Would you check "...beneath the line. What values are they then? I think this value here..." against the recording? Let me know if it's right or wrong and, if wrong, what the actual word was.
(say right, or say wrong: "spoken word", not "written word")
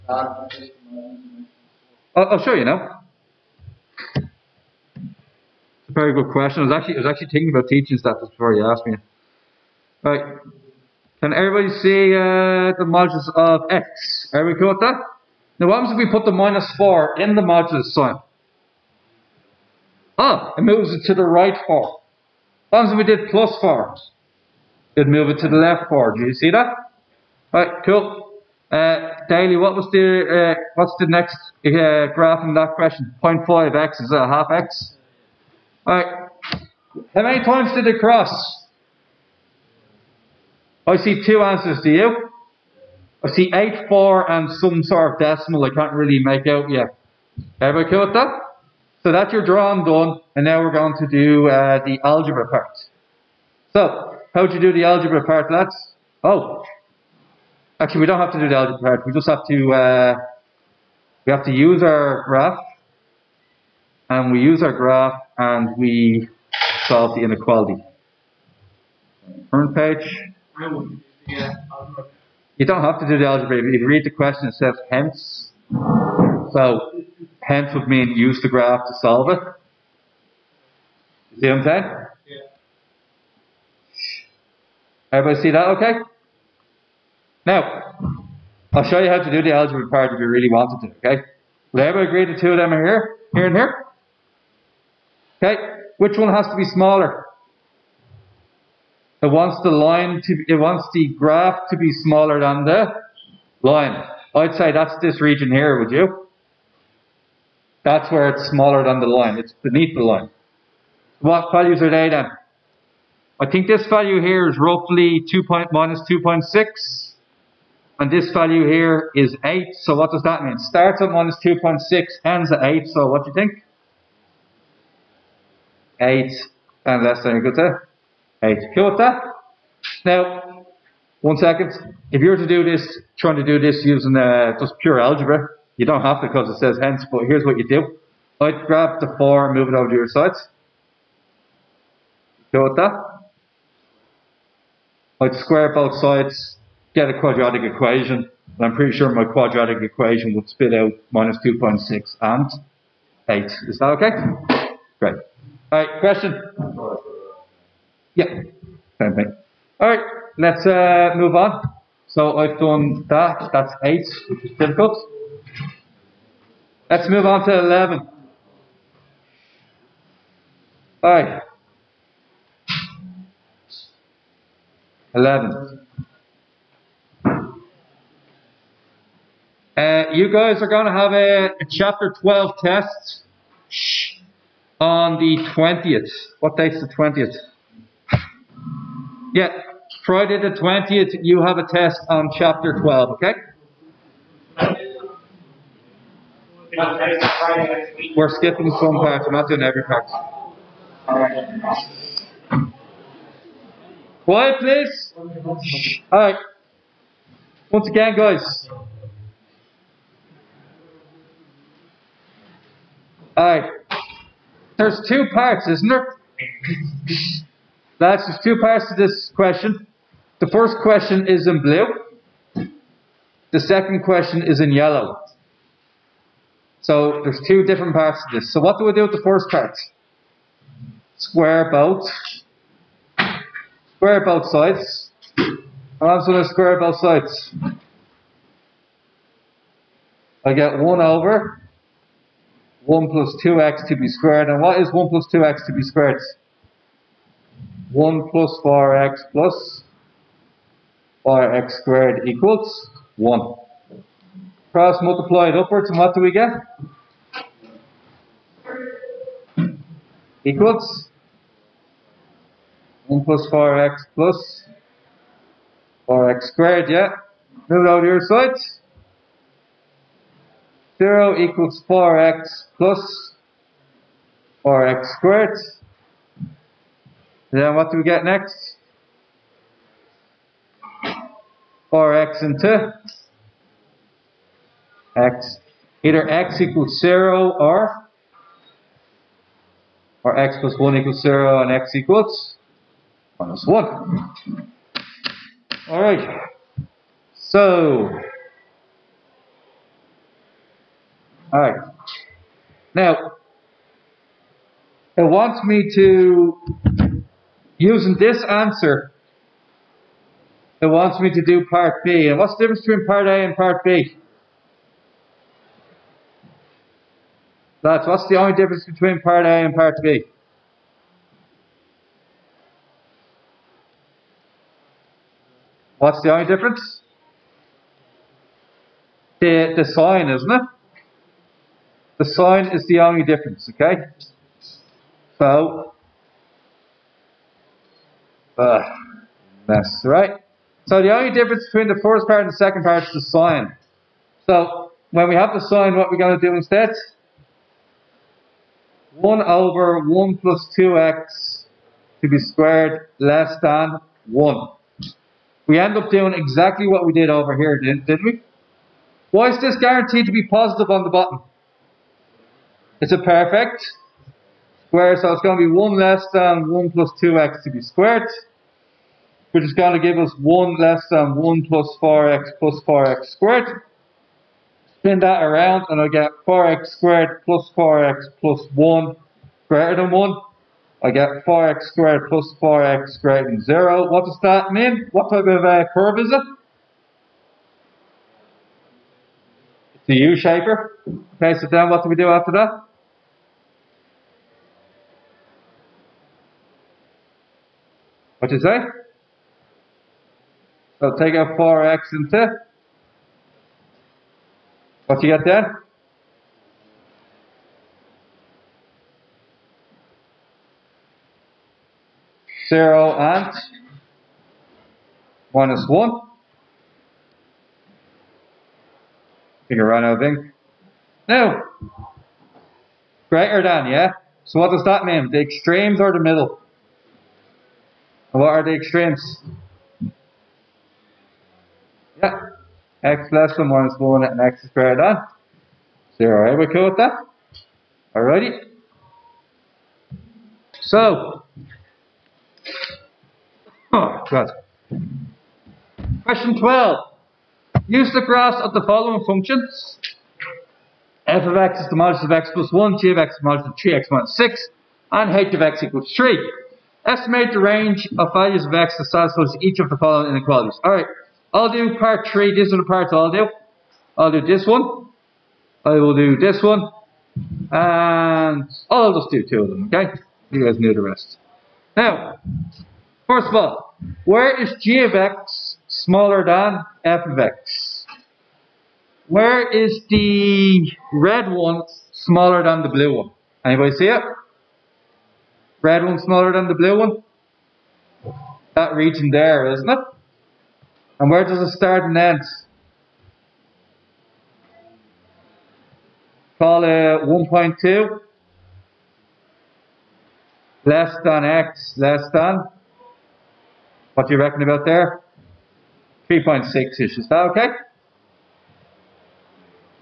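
right.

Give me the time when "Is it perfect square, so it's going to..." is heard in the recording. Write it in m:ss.
6:02.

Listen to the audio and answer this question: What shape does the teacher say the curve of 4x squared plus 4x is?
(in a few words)
U-shaper.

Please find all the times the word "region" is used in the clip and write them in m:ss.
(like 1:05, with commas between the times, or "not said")
1:45, 8:08.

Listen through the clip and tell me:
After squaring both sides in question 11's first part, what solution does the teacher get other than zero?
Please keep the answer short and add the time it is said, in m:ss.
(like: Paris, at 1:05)
-1, at 4:51.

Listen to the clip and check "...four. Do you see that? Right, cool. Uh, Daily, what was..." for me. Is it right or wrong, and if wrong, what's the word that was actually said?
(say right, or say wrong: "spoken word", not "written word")
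right.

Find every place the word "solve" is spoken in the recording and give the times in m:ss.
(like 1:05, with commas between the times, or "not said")
1:06, 1:18.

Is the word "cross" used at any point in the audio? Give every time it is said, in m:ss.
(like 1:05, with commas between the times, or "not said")
0:37, 4:14.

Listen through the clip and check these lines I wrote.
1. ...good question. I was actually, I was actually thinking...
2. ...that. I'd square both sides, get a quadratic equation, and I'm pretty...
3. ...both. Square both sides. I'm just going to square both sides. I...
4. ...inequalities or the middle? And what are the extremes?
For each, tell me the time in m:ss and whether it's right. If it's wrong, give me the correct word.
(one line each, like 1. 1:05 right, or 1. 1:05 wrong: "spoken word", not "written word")
1. 0:06 right
2. 2:22 right
3. 3:51 right
4. 7:05 wrong: "extremes", not "inequalities".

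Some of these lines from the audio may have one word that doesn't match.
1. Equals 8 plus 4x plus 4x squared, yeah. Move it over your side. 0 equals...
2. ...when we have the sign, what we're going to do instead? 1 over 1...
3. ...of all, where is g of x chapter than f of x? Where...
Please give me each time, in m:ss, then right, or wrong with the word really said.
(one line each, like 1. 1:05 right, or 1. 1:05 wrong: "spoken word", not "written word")
1. 4:20 wrong: "1", not "8"
2. 5:45 right
3. 7:53 wrong: "smaller", not "chapter".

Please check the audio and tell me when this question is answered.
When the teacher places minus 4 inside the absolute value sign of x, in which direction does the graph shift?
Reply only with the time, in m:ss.
0:20.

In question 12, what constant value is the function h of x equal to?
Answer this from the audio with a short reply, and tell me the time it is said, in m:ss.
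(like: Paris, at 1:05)
3, at 7:35.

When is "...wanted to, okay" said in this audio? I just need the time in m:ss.
1:30.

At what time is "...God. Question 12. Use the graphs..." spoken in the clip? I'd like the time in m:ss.
7:24.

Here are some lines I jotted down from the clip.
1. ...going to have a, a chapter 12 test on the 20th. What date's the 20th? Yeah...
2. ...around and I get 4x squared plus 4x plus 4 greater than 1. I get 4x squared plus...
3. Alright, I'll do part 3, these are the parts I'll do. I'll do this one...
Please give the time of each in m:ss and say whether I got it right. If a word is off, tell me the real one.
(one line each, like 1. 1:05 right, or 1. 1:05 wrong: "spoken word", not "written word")
1. 3:00 right
2. 6:15 wrong: "1", not "4"
3. 7:40 right.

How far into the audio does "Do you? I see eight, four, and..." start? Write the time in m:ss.
0:41.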